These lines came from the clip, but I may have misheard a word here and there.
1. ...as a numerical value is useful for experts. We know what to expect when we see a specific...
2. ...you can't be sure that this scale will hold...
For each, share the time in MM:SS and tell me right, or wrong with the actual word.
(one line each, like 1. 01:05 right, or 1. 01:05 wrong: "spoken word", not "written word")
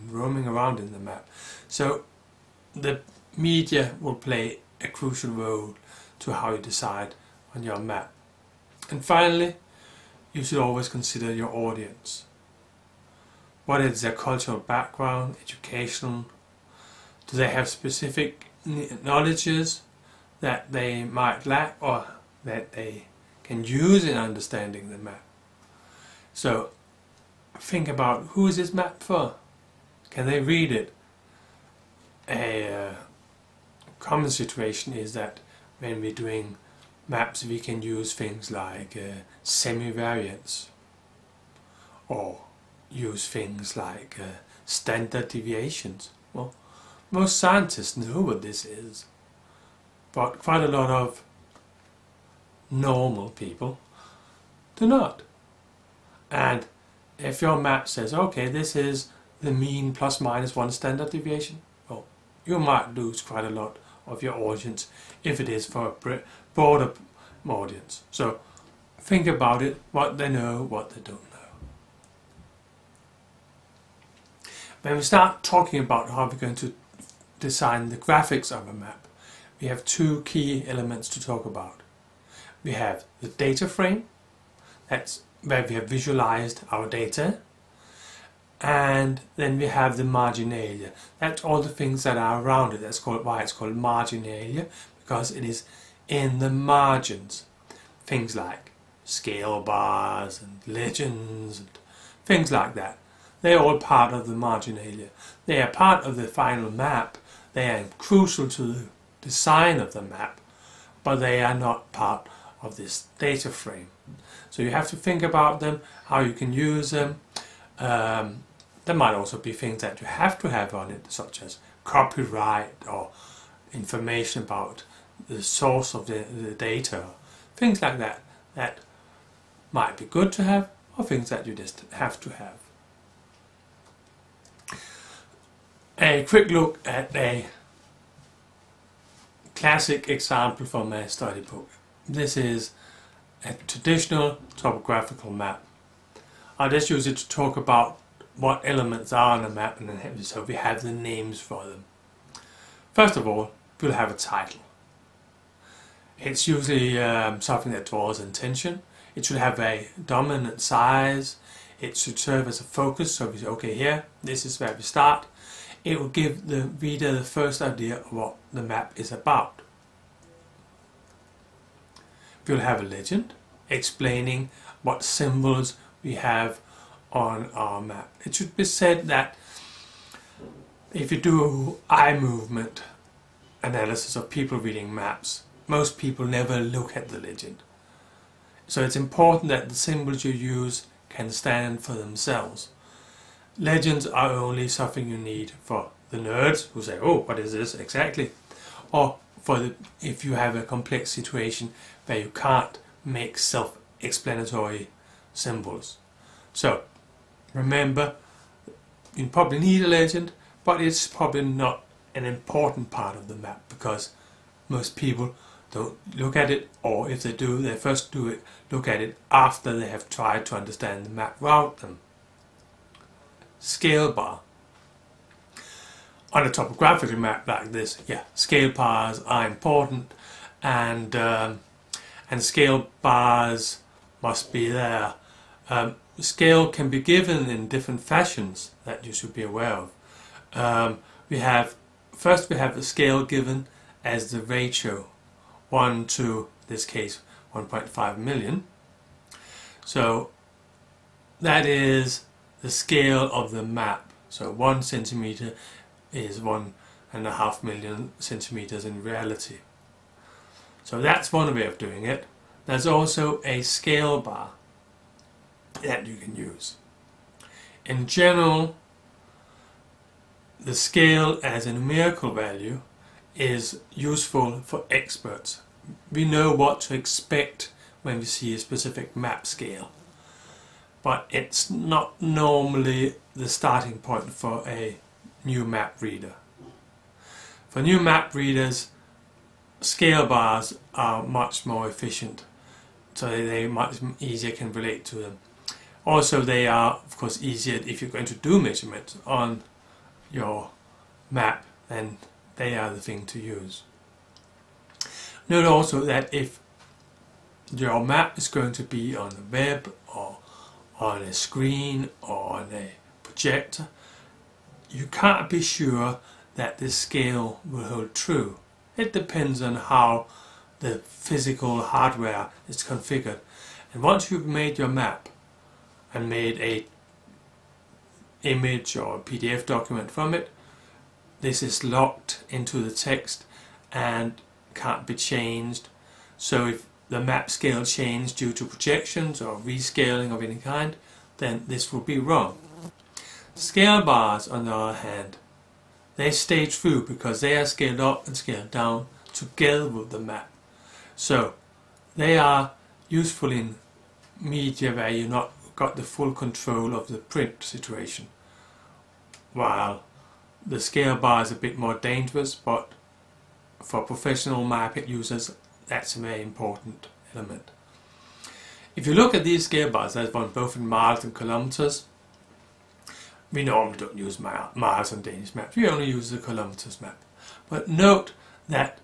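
1. 04:31 right
2. 05:14 right.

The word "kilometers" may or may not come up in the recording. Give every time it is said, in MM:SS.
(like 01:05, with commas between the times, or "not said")
06:11, 06:16.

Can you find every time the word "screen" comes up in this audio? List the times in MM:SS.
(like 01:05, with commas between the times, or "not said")
05:11.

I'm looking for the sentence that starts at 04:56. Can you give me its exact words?
Also they are of course easier if you're going to do measurements on your map then they are the thing to use.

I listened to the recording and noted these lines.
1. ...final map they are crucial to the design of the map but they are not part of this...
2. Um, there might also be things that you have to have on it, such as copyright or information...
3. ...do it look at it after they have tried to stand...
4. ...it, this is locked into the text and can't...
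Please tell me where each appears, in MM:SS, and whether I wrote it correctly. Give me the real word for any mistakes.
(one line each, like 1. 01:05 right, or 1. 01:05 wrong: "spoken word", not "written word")
1. 01:46 right
2. 01:57 right
3. 03:38 wrong: "understand", not "stand"
4. 05:30 right.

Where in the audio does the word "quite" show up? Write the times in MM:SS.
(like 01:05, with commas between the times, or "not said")
00:50, 01:03.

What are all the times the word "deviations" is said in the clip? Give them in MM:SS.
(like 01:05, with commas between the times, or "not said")
00:45, 01:01.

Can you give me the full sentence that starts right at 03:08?
So it's important that the symbols you use can stand for themselves.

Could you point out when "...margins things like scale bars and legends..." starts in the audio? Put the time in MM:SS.
01:36.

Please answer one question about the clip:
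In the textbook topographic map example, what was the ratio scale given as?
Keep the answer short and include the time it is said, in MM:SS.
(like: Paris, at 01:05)
1 to 1.5 million, at 04:05.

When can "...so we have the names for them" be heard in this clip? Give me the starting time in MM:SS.
02:30.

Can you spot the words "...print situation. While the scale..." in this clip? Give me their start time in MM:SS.
05:57.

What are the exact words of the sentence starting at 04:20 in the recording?
So that's one way of doing it.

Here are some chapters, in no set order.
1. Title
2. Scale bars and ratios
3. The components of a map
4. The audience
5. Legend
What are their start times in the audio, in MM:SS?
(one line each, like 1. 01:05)
1. 02:15
2. 03:43
3. 01:16
4. 00:10
5. 02:50.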